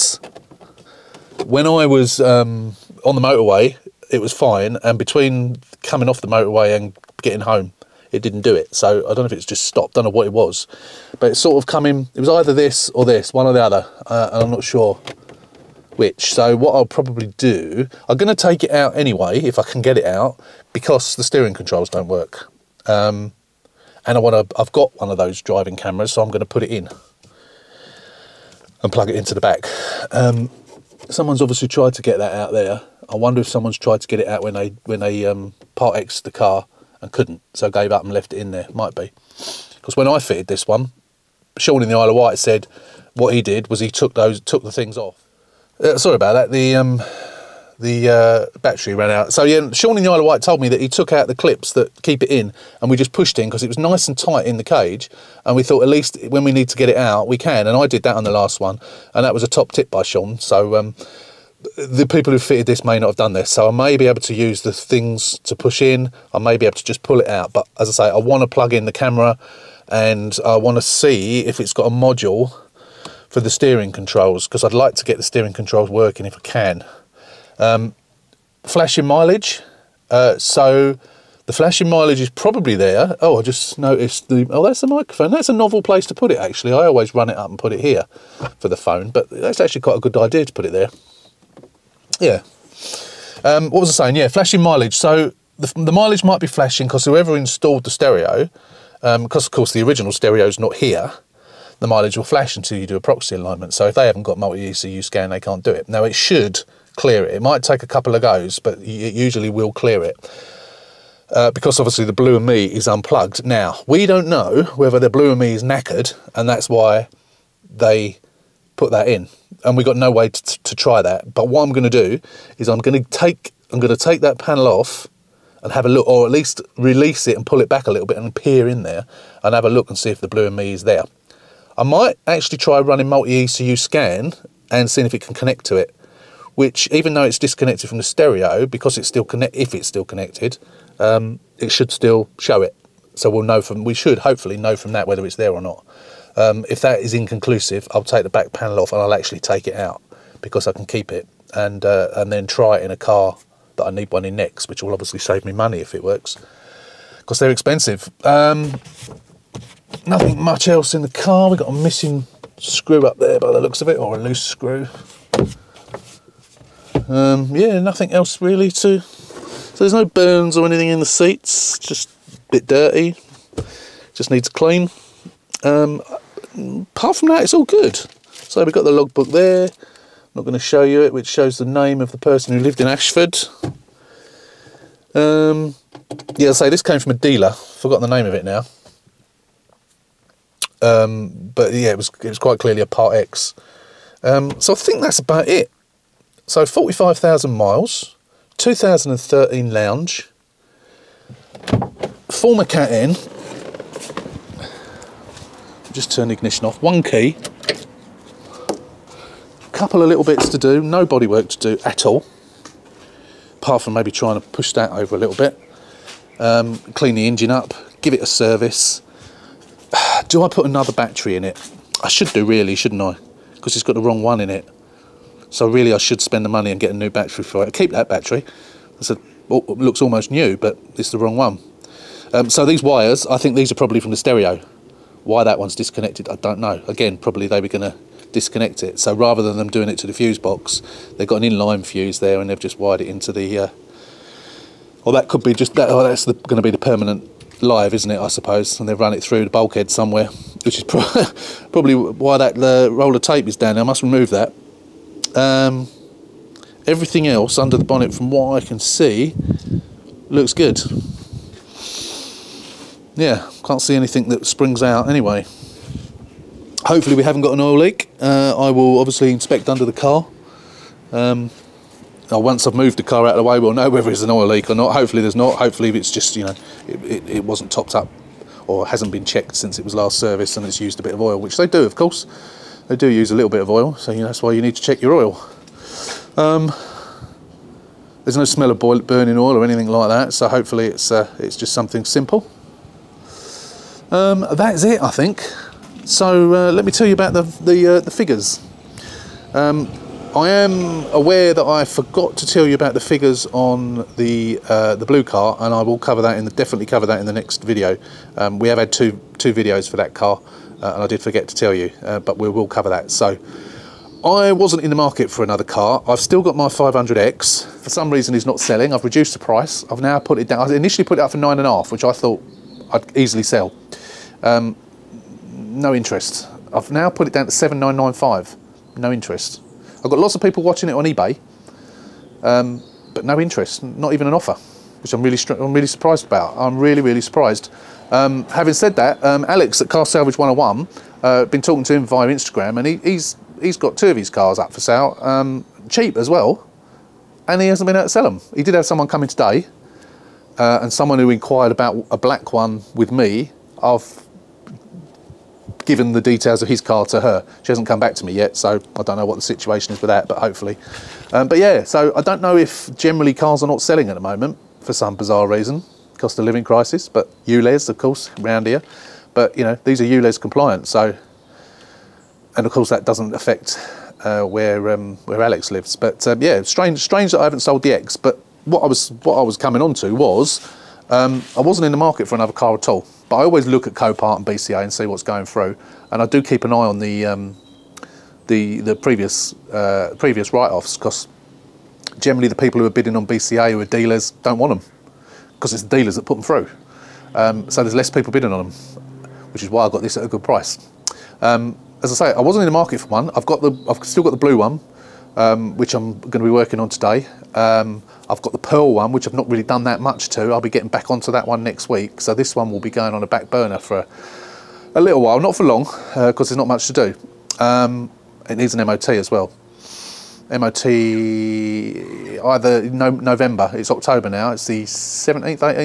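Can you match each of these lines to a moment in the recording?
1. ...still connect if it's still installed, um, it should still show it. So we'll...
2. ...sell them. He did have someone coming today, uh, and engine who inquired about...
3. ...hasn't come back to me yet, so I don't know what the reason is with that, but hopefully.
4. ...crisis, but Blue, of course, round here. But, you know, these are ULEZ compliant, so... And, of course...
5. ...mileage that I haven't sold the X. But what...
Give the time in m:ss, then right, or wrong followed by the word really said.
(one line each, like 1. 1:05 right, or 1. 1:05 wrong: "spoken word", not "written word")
1. 2:19 wrong: "connected", not "installed"
2. 5:48 wrong: "someone", not "engine"
3. 5:57 wrong: "situation", not "reason"
4. 6:06 wrong: "ULEZ", not "Blue"
5. 6:16 wrong: "strange", not "mileage".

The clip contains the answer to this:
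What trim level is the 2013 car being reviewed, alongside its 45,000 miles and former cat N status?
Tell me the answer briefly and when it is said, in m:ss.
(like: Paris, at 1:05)
Lounge, at 3:19.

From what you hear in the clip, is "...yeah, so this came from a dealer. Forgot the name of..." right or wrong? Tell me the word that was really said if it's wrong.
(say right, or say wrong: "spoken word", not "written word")
right.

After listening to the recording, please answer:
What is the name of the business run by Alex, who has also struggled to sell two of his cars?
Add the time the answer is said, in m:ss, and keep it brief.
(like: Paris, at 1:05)
Car Salvage 101, at 5:39.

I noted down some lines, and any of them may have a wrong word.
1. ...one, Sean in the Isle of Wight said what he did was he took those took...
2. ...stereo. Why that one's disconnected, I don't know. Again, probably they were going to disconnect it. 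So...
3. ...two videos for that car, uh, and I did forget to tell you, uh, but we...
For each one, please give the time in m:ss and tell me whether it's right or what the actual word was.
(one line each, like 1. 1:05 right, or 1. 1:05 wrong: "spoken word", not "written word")
1. 0:40 right
2. 3:54 right
3. 5:09 right.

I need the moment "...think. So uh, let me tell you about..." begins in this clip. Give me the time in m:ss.
4:55.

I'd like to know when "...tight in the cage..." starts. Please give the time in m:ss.
0:54.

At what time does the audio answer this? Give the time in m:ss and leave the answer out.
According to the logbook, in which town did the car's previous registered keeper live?
3:02.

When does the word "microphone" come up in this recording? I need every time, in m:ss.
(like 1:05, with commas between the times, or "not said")
1:24.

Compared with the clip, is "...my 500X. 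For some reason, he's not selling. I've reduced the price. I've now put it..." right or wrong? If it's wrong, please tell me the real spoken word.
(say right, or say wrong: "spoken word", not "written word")
right.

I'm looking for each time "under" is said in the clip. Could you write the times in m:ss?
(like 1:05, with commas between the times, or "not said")
4:17, 4:29.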